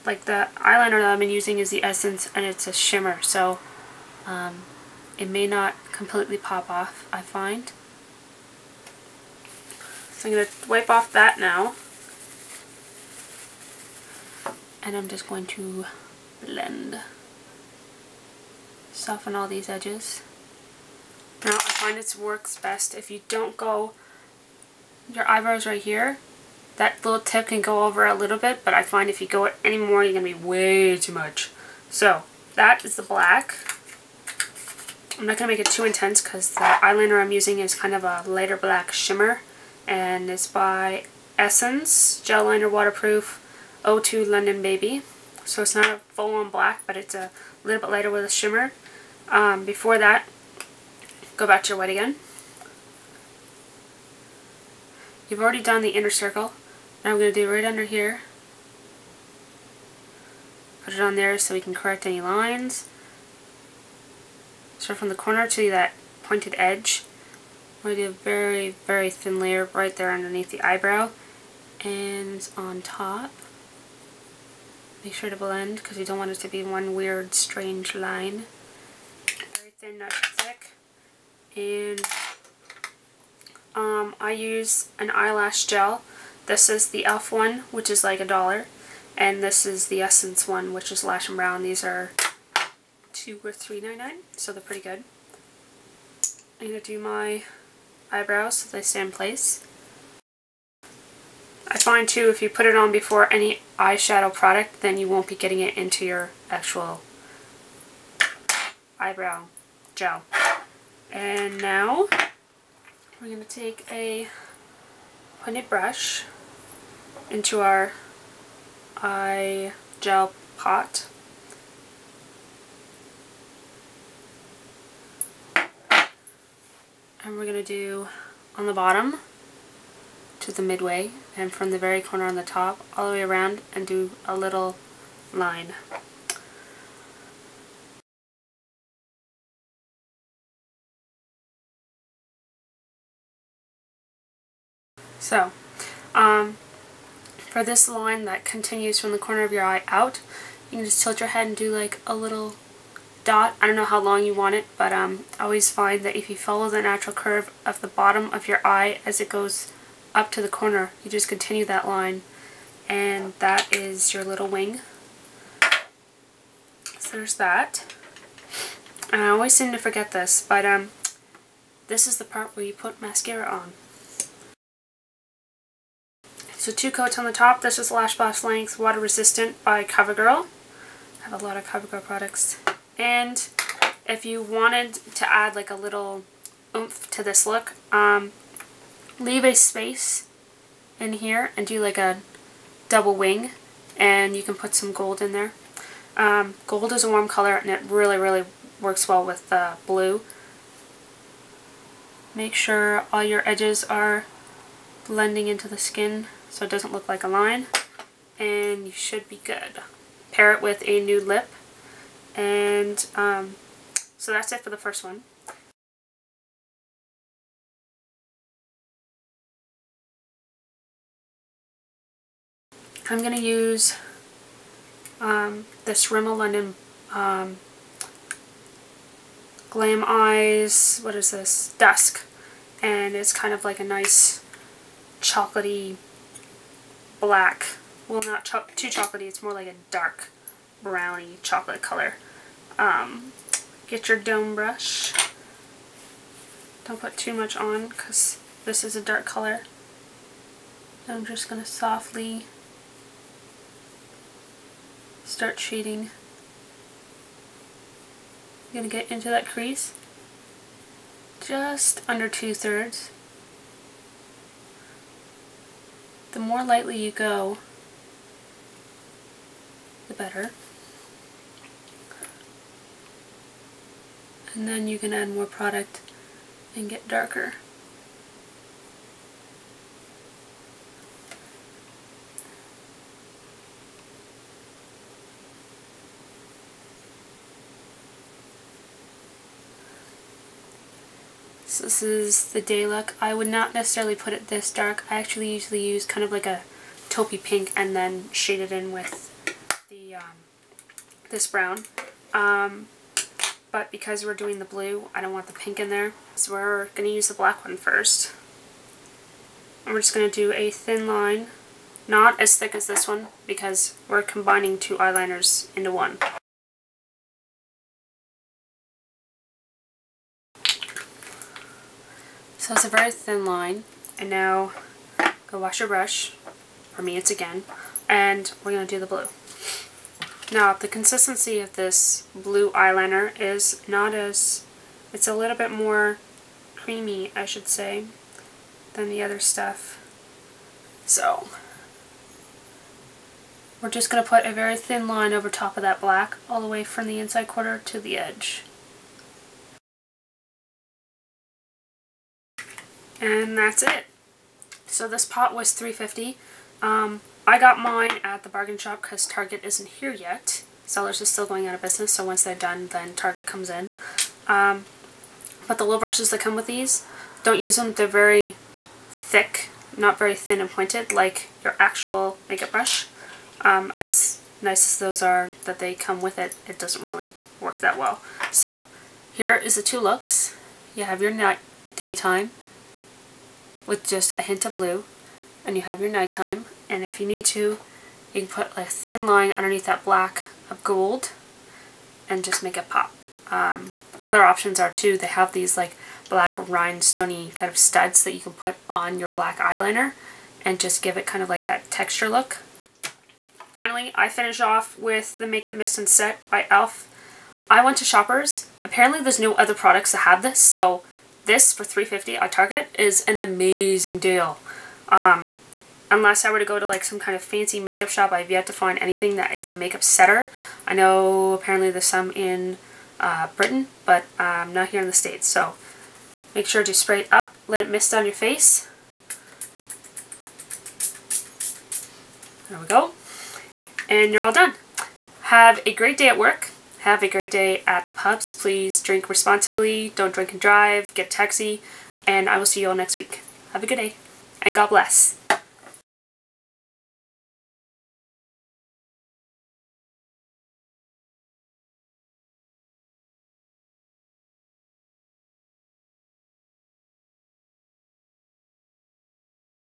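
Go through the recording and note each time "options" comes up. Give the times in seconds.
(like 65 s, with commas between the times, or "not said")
394 s.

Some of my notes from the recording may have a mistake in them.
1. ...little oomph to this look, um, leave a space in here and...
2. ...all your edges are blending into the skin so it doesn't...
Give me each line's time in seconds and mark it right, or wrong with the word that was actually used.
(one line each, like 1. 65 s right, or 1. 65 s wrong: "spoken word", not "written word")
1. 185 s right
2. 203 s right.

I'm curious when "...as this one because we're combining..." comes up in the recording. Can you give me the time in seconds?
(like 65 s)
312 s.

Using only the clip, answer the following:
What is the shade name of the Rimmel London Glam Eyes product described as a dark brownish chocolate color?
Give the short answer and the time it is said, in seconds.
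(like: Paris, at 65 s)
Dusk, at 231 s.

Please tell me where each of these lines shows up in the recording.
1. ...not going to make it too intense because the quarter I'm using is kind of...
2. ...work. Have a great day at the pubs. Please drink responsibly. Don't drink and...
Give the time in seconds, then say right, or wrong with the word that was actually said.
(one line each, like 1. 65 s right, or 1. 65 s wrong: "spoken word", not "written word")
1. 35 s wrong: "eyeliner", not "quarter"
2. 436 s right.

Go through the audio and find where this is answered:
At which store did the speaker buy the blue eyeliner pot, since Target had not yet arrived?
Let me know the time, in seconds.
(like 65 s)
358 s.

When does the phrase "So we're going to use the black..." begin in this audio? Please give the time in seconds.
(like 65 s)
306 s.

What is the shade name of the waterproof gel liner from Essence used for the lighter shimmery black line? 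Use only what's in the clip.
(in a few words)
London Baby.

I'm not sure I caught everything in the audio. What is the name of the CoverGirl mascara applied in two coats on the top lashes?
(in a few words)
Lash Blast Length.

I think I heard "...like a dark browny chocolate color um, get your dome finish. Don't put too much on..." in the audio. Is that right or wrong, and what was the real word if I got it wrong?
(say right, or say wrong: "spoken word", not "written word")
wrong: "brush", not "finish".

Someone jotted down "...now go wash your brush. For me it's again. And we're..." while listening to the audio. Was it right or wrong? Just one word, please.
right.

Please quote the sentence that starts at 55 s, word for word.
You've already done the inner circle.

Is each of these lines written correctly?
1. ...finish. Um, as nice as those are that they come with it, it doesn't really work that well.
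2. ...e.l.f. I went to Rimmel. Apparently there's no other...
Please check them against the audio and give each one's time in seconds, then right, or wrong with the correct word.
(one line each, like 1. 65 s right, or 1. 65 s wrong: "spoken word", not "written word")
1. 372 s wrong: "brush", not "finish"
2. 406 s wrong: "Shoppers", not "Rimmel".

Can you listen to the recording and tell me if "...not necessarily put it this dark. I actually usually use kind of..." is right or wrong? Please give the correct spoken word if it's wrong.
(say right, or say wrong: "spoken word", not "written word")
right.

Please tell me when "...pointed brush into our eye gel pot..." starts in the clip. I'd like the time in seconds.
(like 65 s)
115 s.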